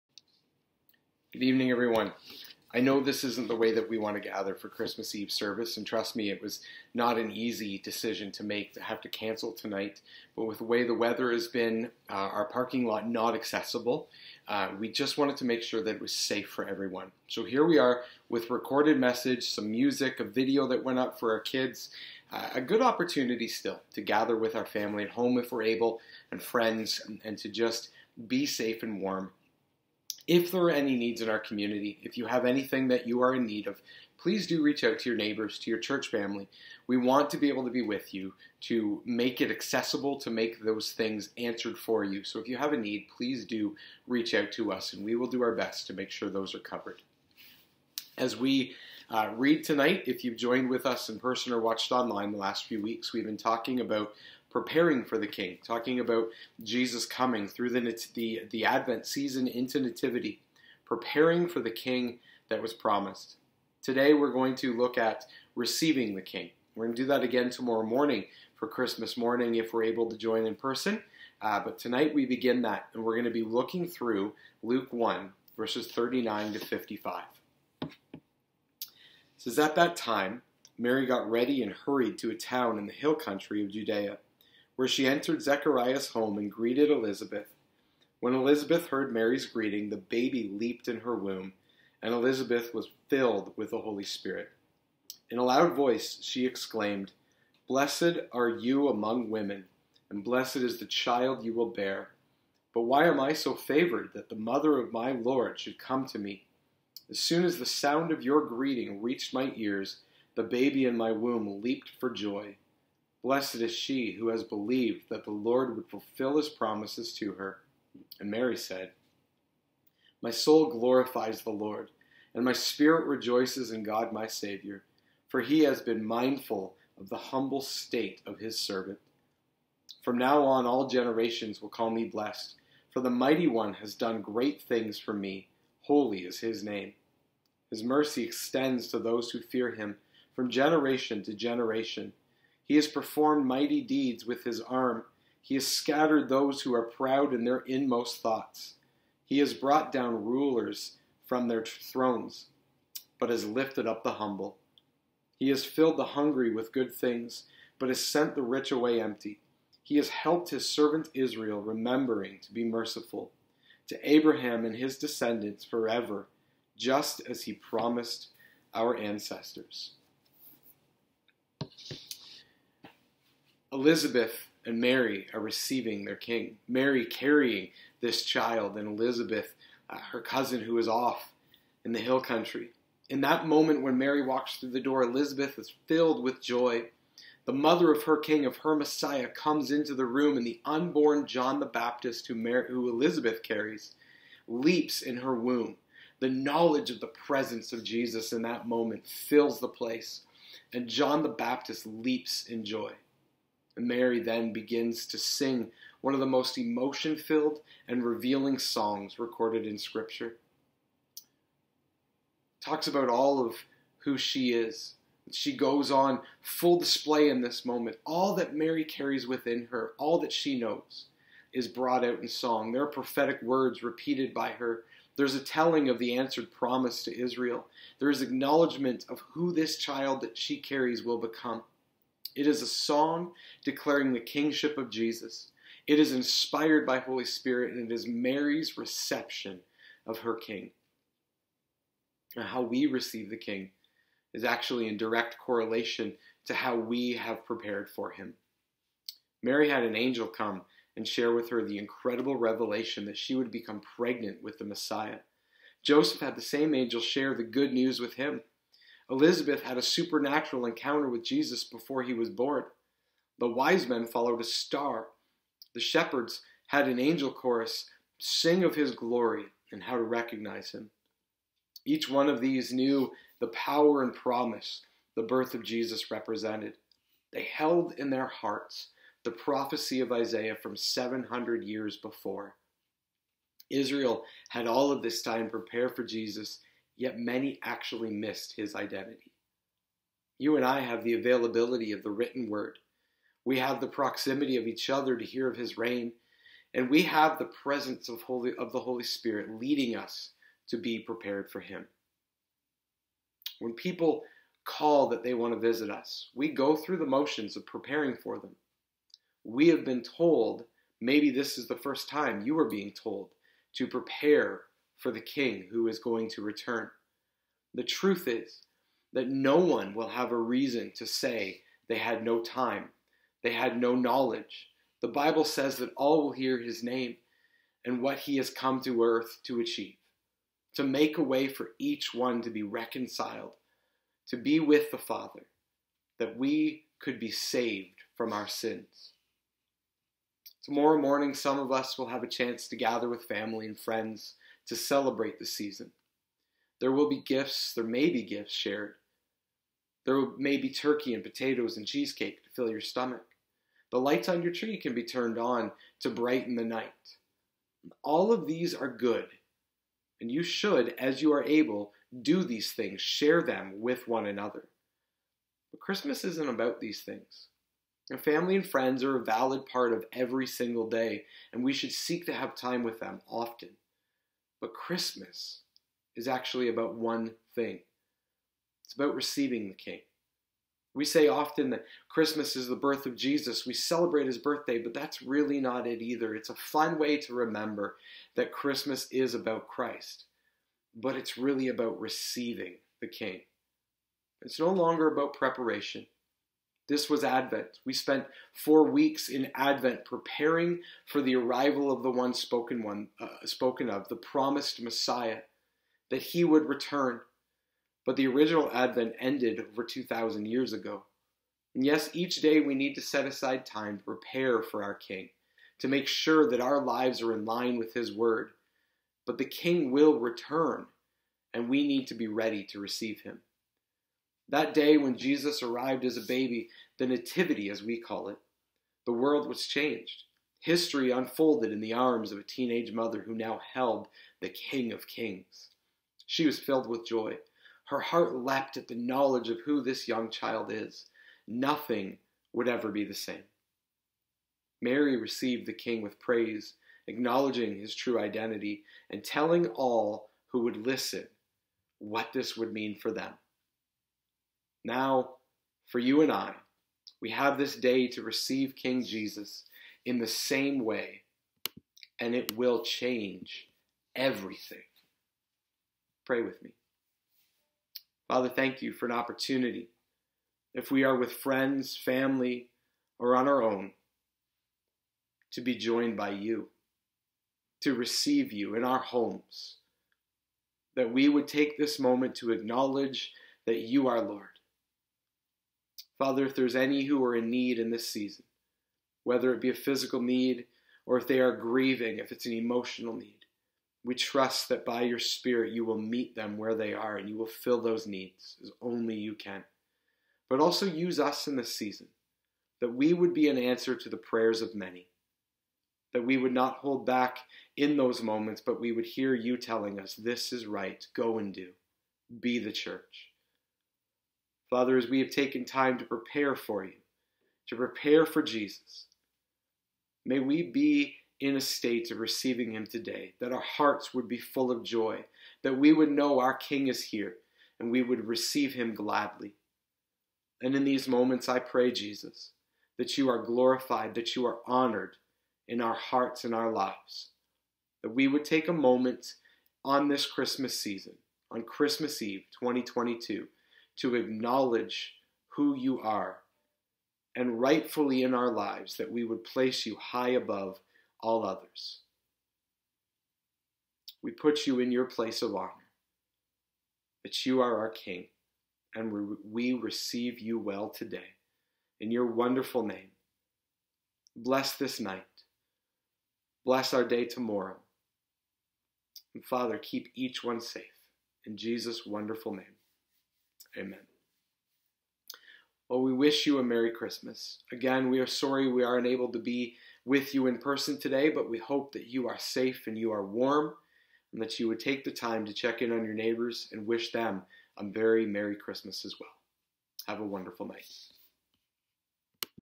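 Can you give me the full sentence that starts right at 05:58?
All of these are good, and you should, as you are able, do these things, share them with one another.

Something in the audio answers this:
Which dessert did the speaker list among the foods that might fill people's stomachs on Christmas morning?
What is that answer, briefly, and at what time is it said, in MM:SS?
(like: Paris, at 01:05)
Cheesecake, at 05:51.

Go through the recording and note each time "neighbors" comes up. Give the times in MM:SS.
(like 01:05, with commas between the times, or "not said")
00:35, 09:46.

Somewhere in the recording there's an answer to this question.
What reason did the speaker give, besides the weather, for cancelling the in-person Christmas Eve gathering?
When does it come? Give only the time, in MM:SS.
00:12.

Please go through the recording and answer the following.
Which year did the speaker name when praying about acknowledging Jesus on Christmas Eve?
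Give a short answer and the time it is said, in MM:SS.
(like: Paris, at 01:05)
2022, at 09:02.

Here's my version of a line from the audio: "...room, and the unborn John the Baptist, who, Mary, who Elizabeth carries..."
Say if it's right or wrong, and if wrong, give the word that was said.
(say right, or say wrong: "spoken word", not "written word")
right.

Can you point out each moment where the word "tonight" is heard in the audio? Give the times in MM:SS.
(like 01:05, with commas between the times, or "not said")
00:09, 00:49, 01:11.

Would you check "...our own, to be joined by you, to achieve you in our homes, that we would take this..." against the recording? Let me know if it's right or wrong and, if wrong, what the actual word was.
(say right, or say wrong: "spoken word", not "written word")
wrong: "receive", not "achieve".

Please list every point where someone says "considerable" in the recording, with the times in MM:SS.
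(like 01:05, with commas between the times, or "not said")
not said.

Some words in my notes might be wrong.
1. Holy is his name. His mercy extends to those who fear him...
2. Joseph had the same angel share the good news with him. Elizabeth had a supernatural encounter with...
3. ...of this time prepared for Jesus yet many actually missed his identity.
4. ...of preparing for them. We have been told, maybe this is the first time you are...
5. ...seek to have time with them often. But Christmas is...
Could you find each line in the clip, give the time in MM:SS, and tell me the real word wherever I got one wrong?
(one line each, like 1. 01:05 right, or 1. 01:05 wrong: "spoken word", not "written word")
1. 02:15 right
2. 04:15 right
3. 04:44 right
4. 05:07 right
5. 06:11 right.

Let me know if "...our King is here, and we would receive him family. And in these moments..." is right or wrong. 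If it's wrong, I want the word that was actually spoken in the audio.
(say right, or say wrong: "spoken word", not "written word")
wrong: "gladly", not "family".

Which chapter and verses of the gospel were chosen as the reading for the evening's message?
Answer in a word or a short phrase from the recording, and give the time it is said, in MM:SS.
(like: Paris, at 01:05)
Luke 1:39-55, at 01:14.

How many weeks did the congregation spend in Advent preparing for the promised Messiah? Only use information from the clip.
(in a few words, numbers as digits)
4.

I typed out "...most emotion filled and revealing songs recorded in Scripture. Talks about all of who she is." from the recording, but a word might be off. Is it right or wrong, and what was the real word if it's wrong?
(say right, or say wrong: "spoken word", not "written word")
right.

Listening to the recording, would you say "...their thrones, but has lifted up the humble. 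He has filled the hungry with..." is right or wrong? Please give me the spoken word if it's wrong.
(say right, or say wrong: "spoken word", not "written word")
right.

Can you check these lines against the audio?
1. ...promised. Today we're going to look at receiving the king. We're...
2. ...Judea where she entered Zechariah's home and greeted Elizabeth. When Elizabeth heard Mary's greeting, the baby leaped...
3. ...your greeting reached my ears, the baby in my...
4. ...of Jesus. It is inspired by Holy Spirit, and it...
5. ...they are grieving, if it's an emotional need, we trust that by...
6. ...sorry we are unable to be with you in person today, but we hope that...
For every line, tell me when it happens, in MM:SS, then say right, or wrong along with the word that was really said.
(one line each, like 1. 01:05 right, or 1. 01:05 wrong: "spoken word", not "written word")
1. 01:02 right
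2. 01:23 right
3. 01:48 right
4. 03:54 right
5. 08:11 right
6. 09:38 right.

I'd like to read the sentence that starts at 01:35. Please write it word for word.
In a loud voice, she exclaimed, Blessed are you among women, and blessed is the child you will bear.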